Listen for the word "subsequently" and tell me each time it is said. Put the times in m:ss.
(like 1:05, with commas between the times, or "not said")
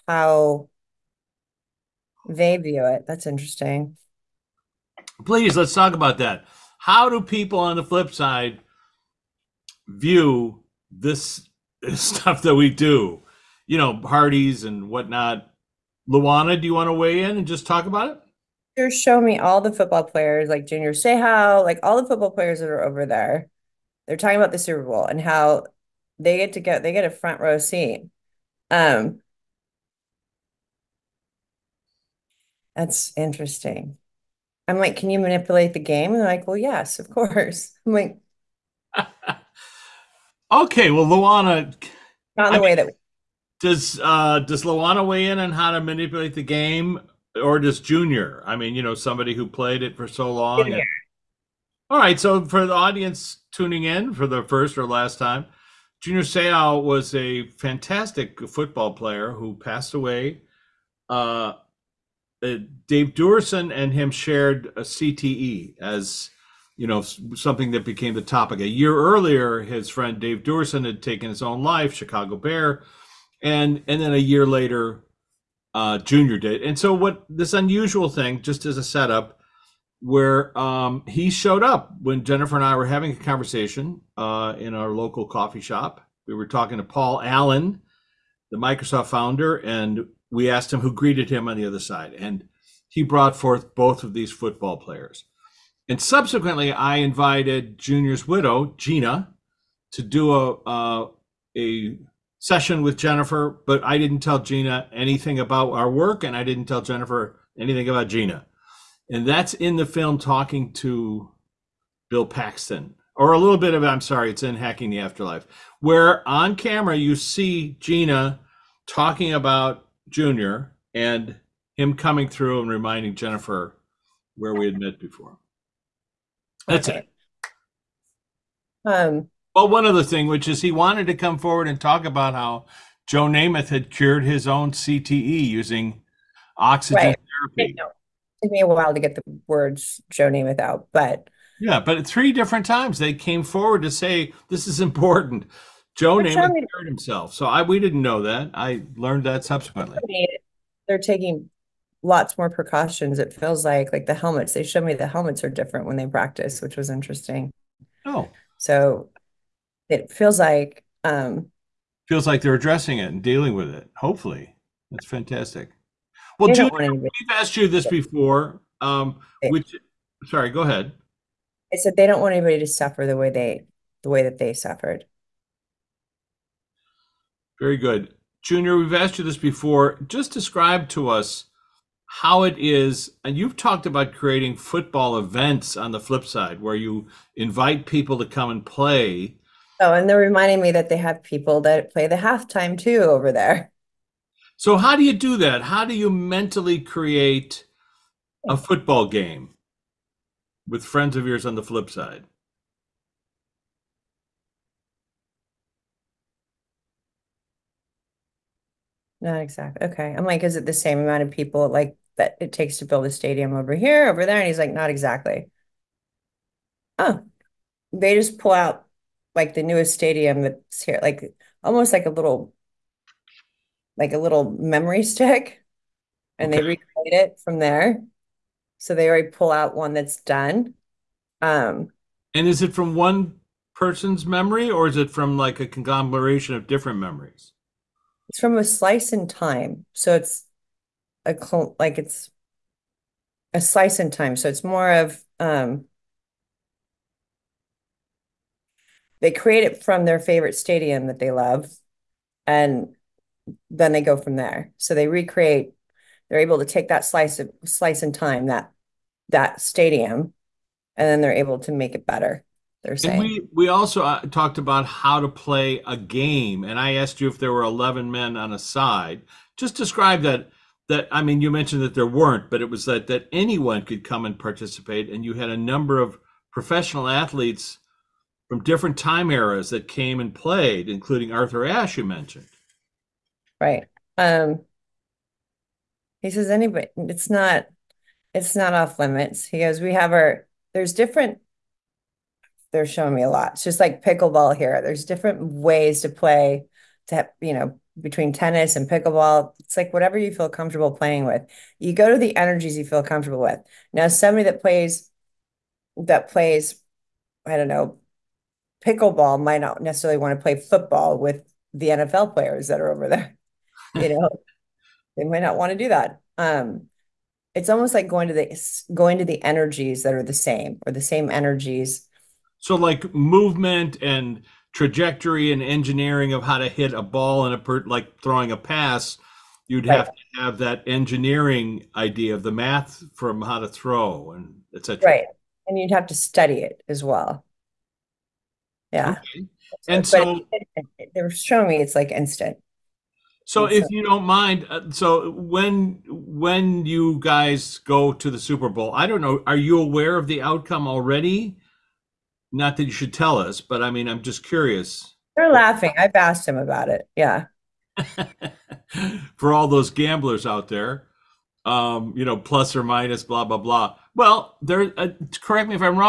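1:36, 2:29.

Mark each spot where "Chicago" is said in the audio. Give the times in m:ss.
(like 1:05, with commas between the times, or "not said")
1:11.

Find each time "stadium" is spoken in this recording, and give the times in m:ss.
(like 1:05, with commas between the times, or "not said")
3:33, 3:39, 4:10, 4:19.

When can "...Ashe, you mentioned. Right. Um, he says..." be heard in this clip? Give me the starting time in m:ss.
4:41.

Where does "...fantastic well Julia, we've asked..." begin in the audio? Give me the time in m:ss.
2:45.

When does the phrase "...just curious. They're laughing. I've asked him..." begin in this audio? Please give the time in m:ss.
5:54.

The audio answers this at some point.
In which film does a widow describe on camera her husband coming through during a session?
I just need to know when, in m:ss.
1:54.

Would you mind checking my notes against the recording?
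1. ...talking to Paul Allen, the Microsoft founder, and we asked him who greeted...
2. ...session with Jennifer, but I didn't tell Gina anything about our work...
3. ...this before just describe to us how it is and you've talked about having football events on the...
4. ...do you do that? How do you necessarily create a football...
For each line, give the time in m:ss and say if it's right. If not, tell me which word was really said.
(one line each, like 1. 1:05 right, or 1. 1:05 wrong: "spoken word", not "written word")
1. 1:26 right
2. 1:42 right
3. 2:59 wrong: "creating", not "having"
4. 3:14 wrong: "mentally", not "necessarily".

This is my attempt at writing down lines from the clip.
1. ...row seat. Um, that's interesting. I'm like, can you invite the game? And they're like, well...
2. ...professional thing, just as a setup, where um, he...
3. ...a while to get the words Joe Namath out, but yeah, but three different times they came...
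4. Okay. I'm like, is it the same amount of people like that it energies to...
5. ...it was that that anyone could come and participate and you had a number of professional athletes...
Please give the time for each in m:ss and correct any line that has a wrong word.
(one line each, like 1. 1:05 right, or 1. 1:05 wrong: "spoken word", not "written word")
1. 0:27 wrong: "manipulate", not "invite"
2. 1:17 wrong: "unusual", not "professional"
3. 2:18 right
4. 3:29 wrong: "takes", not "energies"
5. 4:32 right.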